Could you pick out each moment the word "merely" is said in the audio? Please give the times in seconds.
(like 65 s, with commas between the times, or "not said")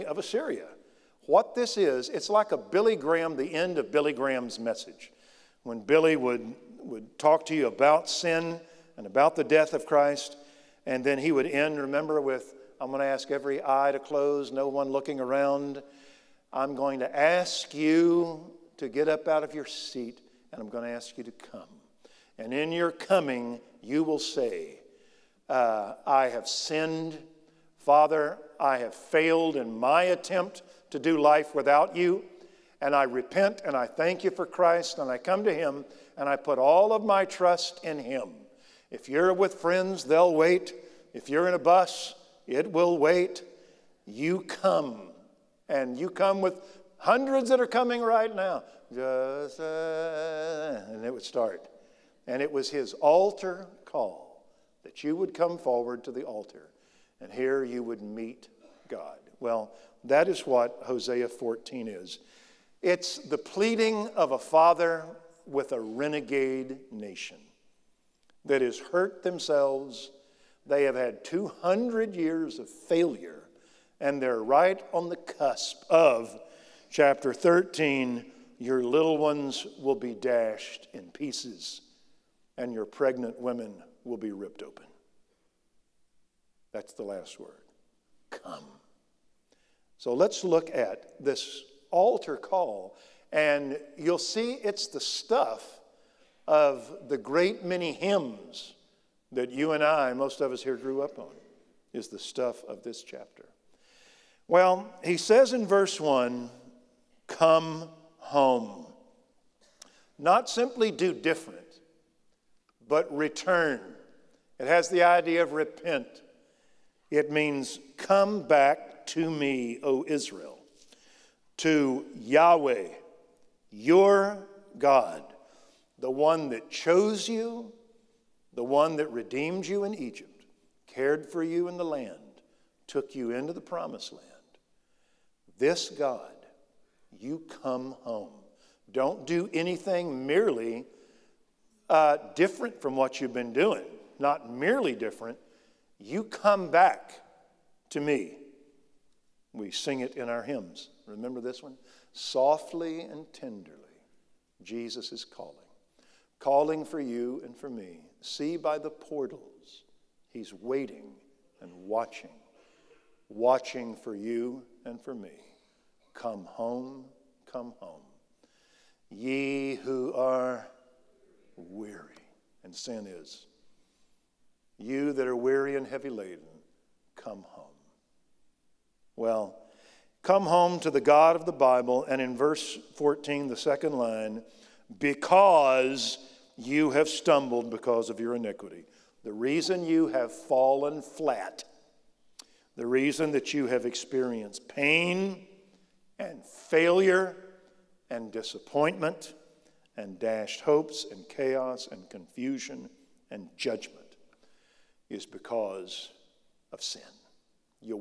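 140 s, 144 s.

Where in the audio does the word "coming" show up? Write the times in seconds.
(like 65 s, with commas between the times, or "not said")
22 s, 47 s.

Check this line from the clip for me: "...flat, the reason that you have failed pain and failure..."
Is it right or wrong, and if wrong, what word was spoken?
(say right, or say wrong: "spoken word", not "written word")
wrong: "experienced", not "failed".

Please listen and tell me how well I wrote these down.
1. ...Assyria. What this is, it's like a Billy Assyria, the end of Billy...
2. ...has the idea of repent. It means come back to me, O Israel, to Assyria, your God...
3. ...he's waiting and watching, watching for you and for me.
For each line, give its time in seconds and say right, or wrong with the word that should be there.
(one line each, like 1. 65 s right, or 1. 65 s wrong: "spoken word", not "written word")
1. 0 s wrong: "Graham", not "Assyria"
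2. 114 s wrong: "Yahweh", not "Assyria"
3. 160 s right.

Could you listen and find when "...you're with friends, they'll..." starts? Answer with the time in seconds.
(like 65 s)
39 s.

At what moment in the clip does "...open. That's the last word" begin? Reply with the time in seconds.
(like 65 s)
84 s.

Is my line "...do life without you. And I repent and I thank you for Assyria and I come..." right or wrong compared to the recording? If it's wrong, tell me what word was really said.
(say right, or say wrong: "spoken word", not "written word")
wrong: "Christ", not "Assyria".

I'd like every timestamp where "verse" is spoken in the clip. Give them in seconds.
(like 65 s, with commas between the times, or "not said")
105 s, 182 s.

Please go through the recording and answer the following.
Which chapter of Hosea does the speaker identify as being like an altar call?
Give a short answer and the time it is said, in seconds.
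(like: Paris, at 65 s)
Hosea 14, at 60 s.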